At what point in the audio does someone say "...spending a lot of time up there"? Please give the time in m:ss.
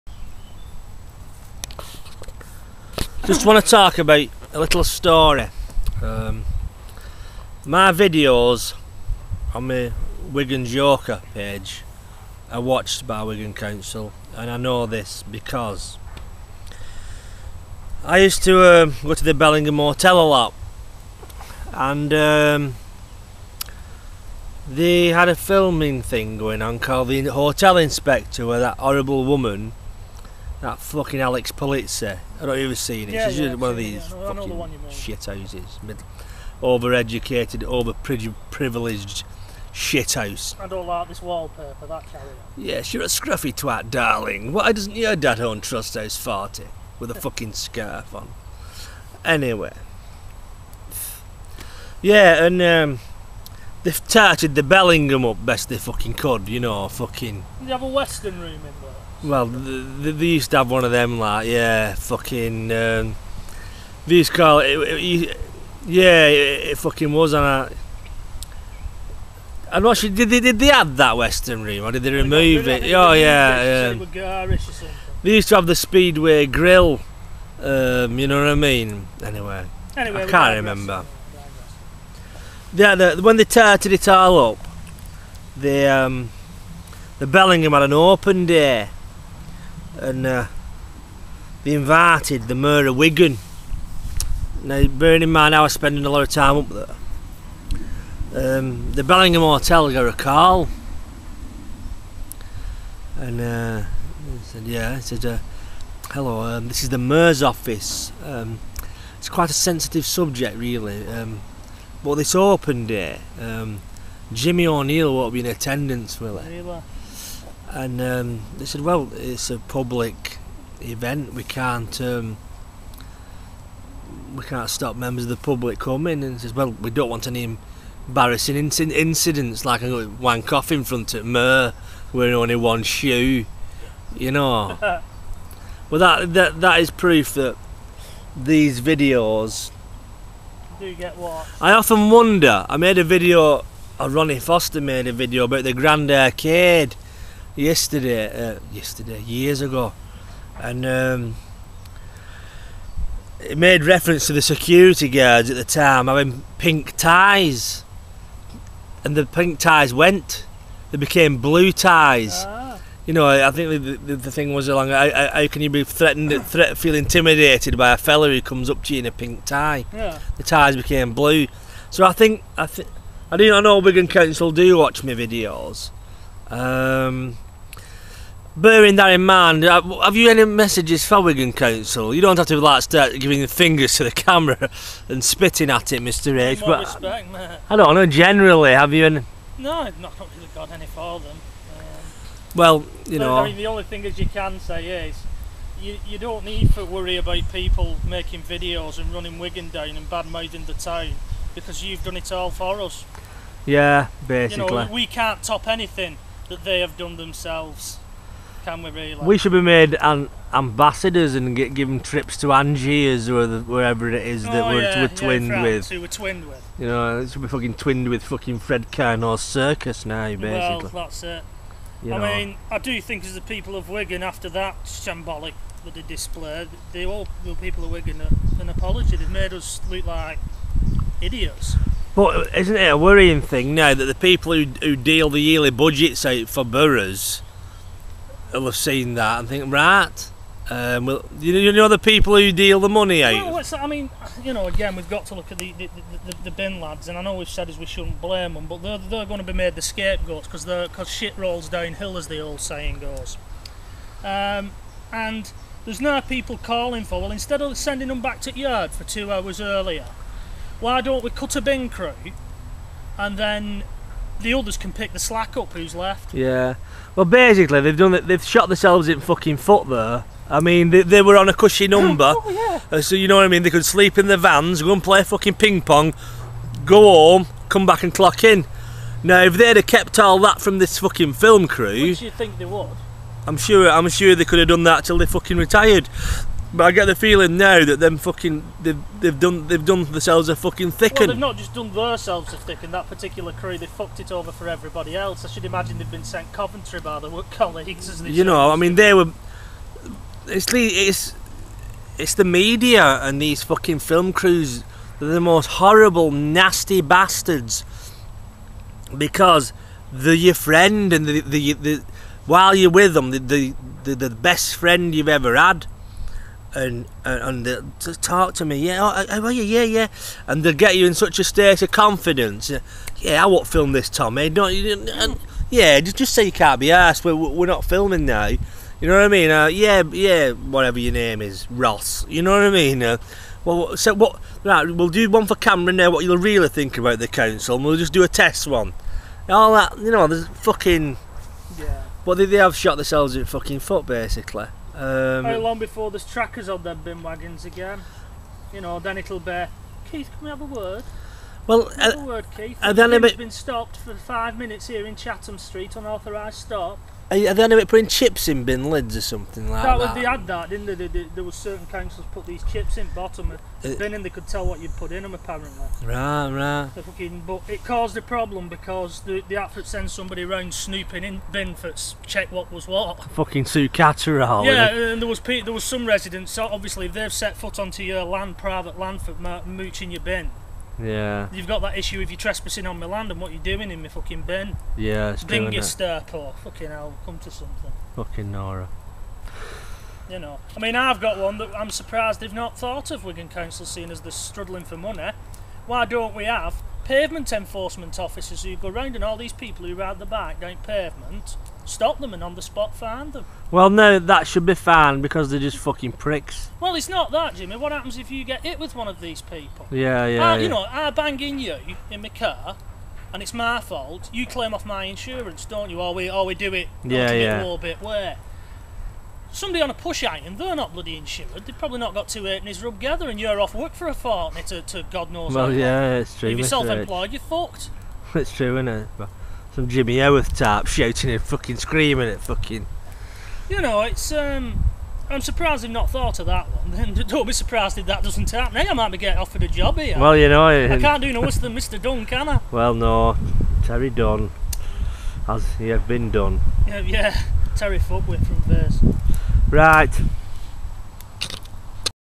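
1:35.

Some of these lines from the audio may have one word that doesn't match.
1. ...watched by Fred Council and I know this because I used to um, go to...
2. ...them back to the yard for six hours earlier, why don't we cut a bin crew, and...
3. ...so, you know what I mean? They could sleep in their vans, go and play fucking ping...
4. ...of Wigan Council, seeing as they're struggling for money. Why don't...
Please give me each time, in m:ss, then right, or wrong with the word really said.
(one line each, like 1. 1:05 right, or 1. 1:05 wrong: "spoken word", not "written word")
1. 0:12 wrong: "Wigan", not "Fred"
2. 4:18 wrong: "two", not "six"
3. 4:33 right
4. 6:33 right.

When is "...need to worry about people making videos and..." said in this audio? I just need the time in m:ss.
3:16.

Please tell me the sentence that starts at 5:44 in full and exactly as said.
Um, How long before there's trackers on their bin wagons again?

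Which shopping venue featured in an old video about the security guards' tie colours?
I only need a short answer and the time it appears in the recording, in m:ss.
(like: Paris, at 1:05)
Grand Arcade, at 2:25.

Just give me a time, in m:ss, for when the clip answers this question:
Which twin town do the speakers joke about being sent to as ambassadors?
3:32.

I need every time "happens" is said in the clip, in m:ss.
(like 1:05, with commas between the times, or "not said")
6:47, 7:18.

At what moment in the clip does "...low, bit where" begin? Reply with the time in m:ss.
6:57.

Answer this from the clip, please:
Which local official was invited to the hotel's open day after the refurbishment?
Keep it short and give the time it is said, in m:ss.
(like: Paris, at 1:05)
Mayor of Wigan, at 1:32.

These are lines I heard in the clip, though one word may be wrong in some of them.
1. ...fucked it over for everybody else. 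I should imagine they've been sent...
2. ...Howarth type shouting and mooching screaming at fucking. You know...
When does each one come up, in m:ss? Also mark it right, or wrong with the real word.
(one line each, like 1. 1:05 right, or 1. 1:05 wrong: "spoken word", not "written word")
1. 4:53 right
2. 7:10 wrong: "fucking", not "mooching".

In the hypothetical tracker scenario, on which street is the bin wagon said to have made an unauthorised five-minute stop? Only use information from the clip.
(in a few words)
Chatham Street.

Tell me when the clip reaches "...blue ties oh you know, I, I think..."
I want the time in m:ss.
2:41.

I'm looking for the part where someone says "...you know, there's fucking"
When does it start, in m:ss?
5:39.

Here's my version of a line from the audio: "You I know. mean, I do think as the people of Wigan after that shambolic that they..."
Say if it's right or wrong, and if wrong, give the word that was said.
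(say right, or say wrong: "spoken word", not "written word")
right.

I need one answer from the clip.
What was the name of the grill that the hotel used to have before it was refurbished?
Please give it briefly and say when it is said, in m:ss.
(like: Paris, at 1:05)
Speedway Grill, at 1:15.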